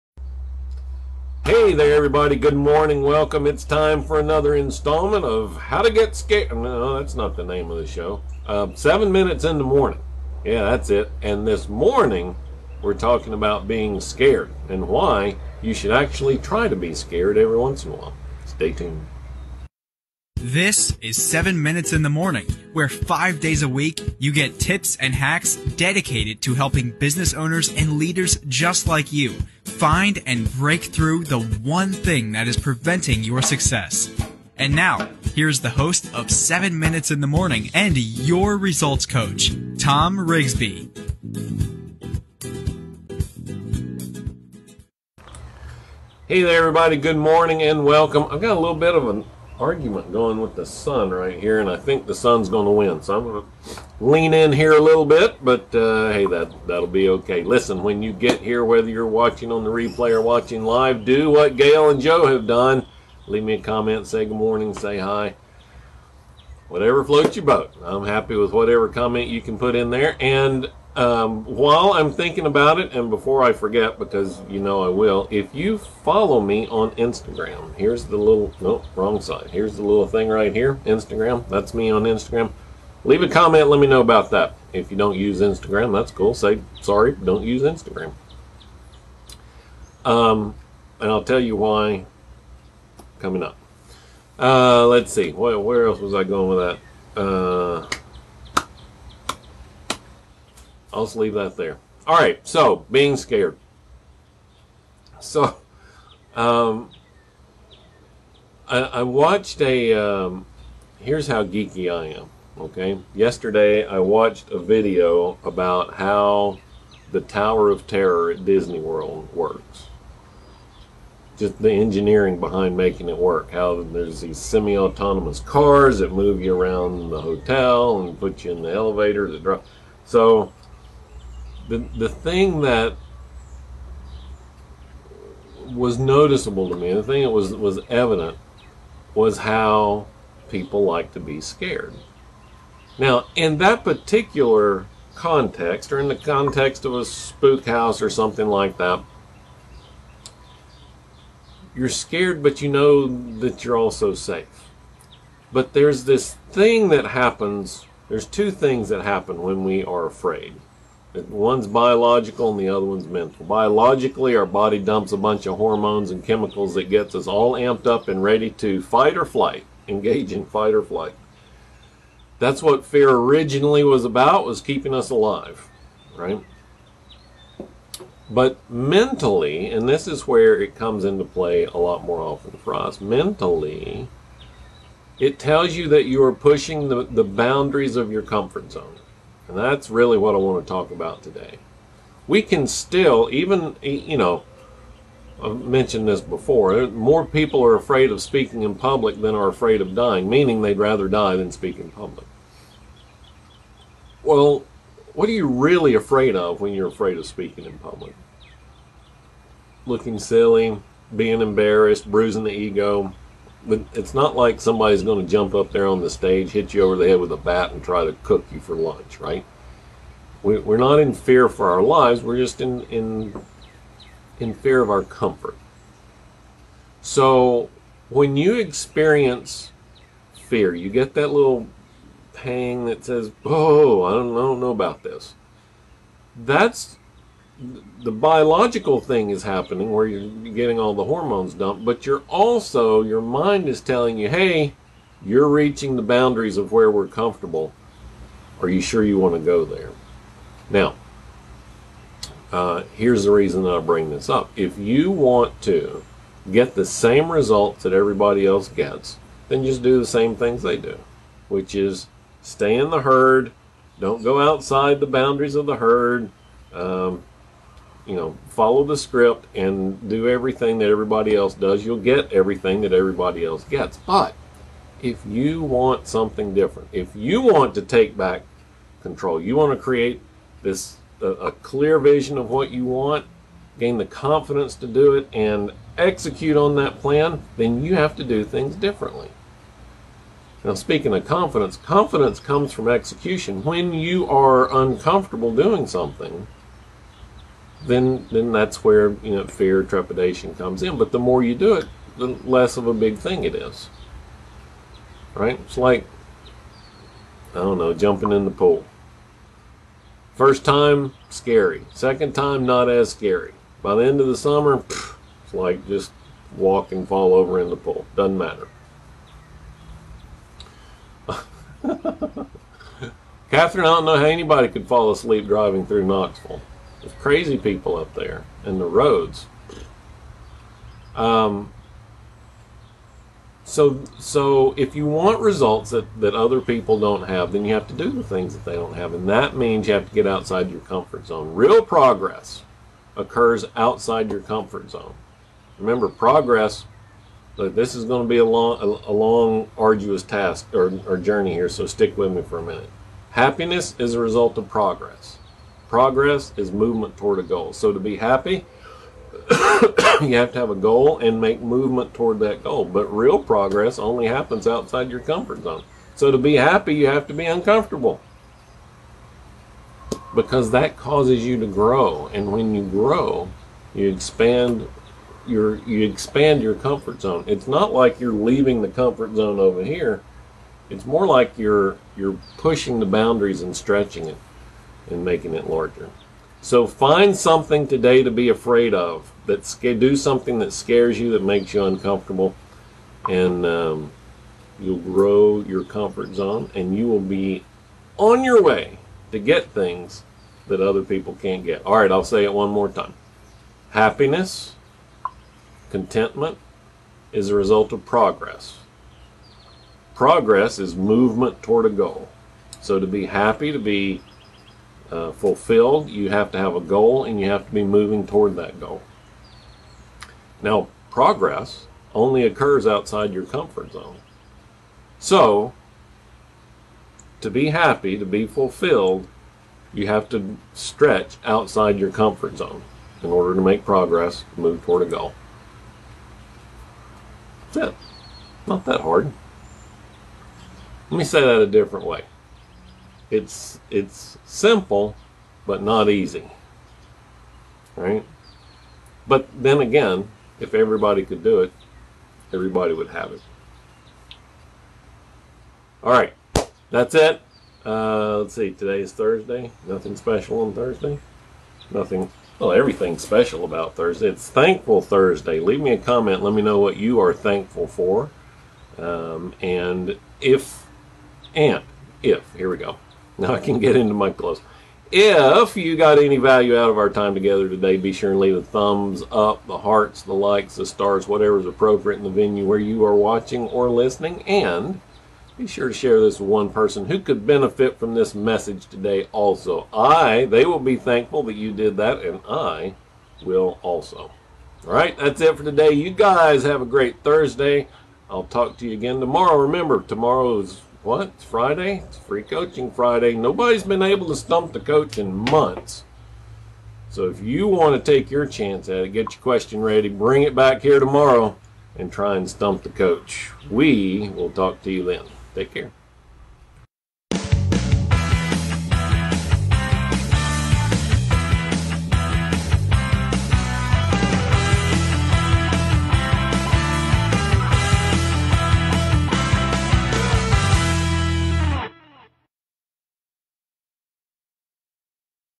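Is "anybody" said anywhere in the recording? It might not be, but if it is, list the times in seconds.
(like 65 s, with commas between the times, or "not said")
324 s.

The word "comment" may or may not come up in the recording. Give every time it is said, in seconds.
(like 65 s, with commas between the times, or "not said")
63 s, 68 s, 83 s, 465 s.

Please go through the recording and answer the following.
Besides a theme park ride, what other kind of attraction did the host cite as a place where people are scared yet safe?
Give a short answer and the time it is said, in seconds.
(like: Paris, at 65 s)
spook house, at 147 s.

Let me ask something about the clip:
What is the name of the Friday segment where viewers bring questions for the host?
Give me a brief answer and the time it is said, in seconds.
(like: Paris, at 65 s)
Free Coaching Friday, at 502 s.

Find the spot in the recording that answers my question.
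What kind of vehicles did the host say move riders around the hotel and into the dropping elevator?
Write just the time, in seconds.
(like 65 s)
124 s.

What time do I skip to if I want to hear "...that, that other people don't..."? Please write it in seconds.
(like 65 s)
335 s.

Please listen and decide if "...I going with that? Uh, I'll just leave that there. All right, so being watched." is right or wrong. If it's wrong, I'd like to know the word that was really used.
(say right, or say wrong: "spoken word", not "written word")
wrong: "scared", not "watched".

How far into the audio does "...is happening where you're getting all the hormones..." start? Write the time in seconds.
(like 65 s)
239 s.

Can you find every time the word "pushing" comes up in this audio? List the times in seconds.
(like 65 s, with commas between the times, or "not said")
186 s, 382 s.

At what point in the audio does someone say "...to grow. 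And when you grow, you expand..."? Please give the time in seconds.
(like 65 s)
371 s.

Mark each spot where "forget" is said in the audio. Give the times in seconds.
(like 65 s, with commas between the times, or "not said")
73 s.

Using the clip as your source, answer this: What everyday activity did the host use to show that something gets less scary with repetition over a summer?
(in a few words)
jumping in the pool.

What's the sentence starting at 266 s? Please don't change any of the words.
Um, you know, follow the script and do everything that everybody else does, you'll get everything that everybody else gets.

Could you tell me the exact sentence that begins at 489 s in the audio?
I, they will be thankful that you did that, and I will also.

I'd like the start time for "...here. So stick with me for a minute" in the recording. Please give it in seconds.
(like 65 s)
351 s.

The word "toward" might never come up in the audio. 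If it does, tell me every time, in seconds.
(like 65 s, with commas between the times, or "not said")
357 s, 362 s, 411 s, 418 s, 434 s.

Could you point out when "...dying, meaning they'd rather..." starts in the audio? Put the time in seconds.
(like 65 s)
199 s.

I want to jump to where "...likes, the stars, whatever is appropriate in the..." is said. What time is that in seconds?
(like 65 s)
480 s.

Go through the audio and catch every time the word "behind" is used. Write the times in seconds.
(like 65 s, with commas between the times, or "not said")
122 s.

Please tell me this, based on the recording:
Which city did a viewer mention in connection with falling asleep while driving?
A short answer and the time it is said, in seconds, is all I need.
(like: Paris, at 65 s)
Knoxville, at 326 s.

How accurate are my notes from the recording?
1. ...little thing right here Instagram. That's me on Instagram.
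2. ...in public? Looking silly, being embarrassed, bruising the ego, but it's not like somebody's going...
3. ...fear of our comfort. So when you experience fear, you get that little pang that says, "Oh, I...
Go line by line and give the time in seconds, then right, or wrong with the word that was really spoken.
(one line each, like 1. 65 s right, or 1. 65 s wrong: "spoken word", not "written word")
1. 79 s right
2. 207 s right
3. 224 s right.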